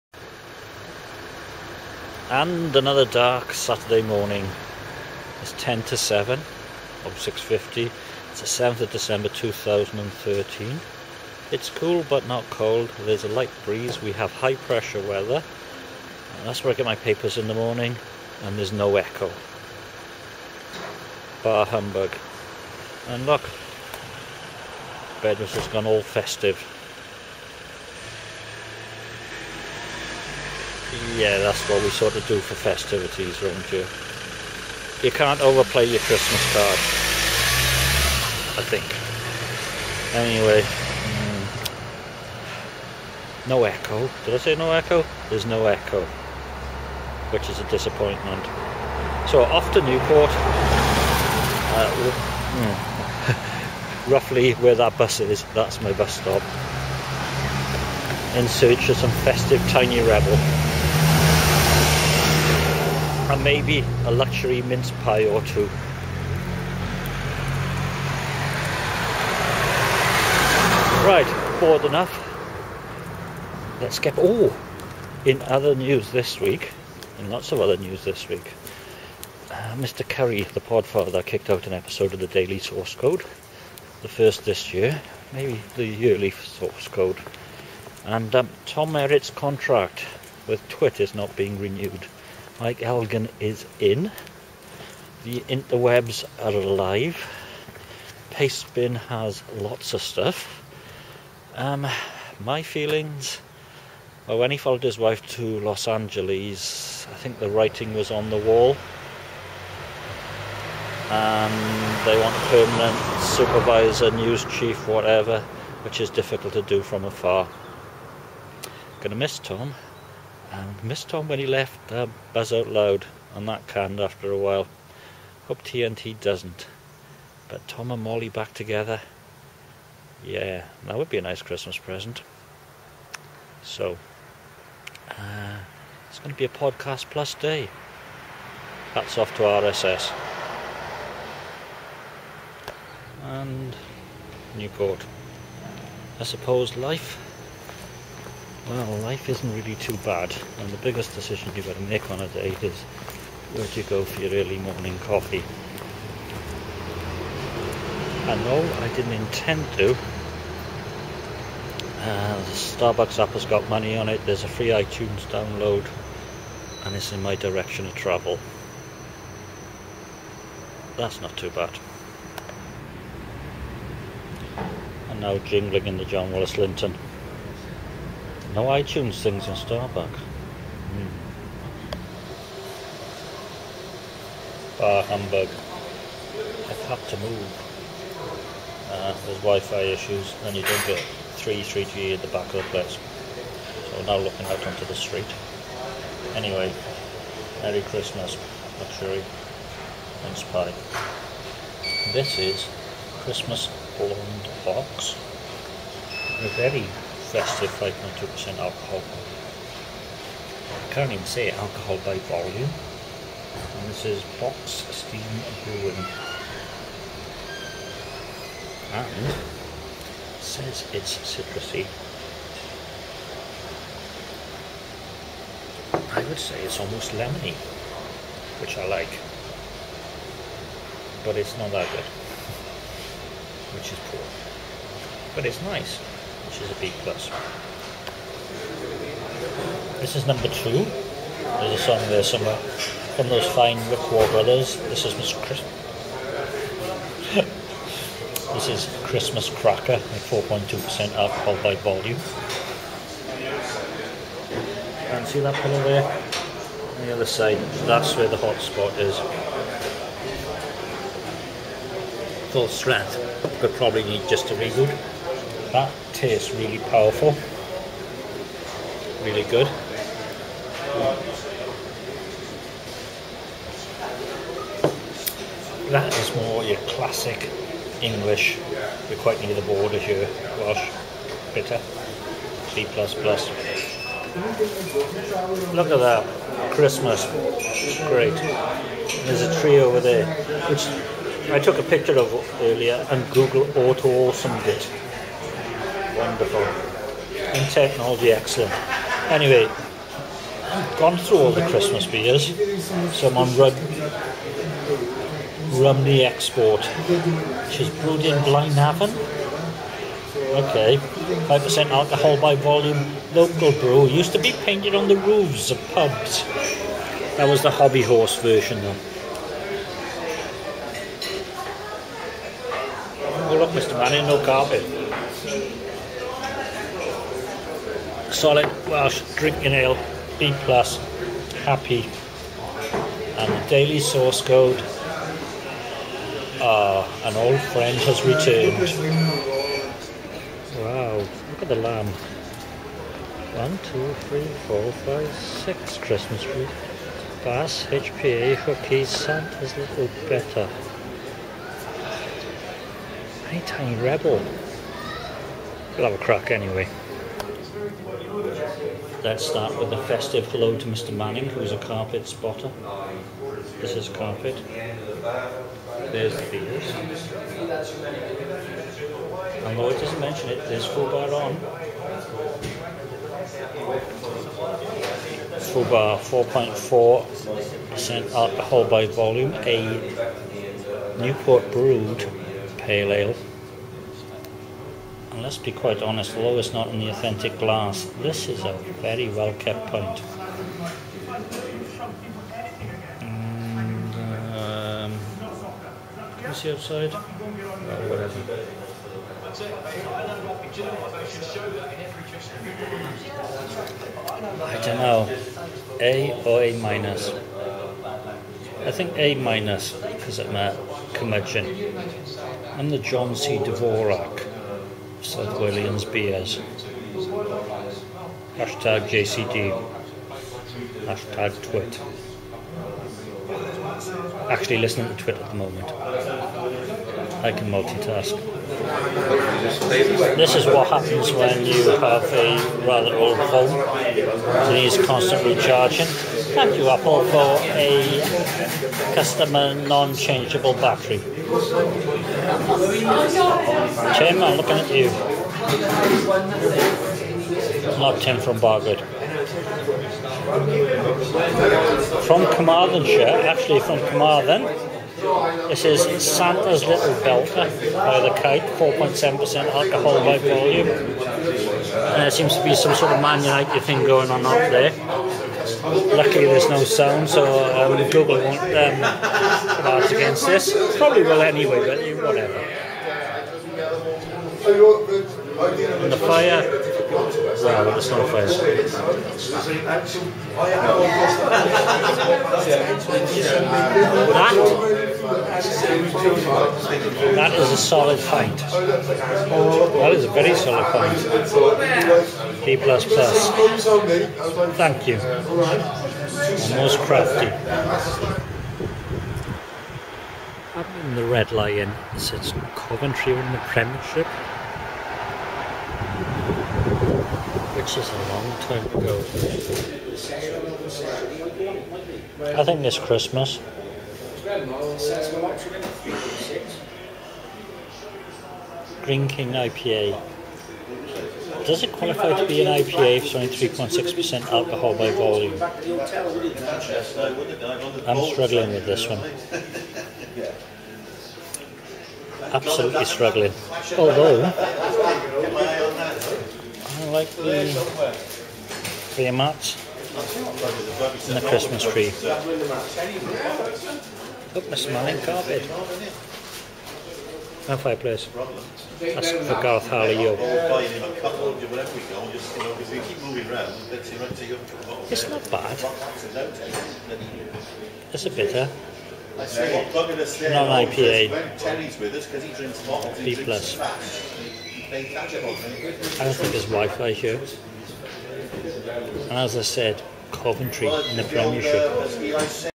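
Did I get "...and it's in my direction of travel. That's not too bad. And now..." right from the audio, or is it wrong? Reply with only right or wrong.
right.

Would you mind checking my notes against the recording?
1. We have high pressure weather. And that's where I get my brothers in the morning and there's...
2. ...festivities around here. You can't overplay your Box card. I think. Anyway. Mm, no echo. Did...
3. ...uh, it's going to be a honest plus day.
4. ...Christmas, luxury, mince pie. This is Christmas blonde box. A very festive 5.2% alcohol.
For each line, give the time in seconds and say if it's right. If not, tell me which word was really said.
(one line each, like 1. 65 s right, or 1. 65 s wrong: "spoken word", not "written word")
1. 14 s wrong: "papers", not "brothers"
2. 32 s wrong: "Christmas", not "Box"
3. 135 s wrong: "podcast", not "honest"
4. 197 s right.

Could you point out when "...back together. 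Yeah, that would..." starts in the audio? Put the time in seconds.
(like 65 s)
128 s.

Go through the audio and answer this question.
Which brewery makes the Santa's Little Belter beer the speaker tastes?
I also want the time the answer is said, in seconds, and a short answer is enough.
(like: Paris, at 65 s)
the Kite, at 458 s.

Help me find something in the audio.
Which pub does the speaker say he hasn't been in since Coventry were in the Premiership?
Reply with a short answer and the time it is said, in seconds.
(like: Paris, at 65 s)
Red Lion, at 501 s.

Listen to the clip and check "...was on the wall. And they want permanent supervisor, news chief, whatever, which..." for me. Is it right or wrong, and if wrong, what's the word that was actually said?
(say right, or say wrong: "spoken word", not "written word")
right.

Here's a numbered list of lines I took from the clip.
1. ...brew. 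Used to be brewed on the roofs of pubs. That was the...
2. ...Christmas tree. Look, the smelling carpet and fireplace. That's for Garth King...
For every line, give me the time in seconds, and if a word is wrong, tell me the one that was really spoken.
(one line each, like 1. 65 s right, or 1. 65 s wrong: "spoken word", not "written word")
1. 313 s wrong: "painted", not "brewed"
2. 541 s wrong: "Harley", not "King".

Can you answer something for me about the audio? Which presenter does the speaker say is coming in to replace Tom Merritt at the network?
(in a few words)
Mike Elgan.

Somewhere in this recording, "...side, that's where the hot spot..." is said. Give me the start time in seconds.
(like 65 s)
257 s.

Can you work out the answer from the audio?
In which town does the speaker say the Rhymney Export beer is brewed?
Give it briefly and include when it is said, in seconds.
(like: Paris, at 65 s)
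Blaenavon, at 308 s.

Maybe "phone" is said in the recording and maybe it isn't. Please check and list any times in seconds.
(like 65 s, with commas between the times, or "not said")
433 s.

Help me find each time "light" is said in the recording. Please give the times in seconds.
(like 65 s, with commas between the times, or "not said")
13 s.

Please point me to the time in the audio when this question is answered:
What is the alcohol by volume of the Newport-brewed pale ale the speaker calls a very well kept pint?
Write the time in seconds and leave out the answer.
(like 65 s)
376 s.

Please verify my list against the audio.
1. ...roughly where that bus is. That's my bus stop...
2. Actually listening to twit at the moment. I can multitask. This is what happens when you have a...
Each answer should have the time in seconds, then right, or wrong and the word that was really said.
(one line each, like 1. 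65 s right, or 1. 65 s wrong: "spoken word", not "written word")
1. 54 s right
2. 424 s right.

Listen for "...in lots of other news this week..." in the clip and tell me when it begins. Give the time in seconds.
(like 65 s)
77 s.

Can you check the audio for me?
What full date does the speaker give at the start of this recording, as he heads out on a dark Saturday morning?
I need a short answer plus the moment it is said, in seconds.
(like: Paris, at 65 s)
7 December 2013, at 8 s.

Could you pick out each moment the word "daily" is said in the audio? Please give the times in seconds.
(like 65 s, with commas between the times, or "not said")
82 s, 333 s.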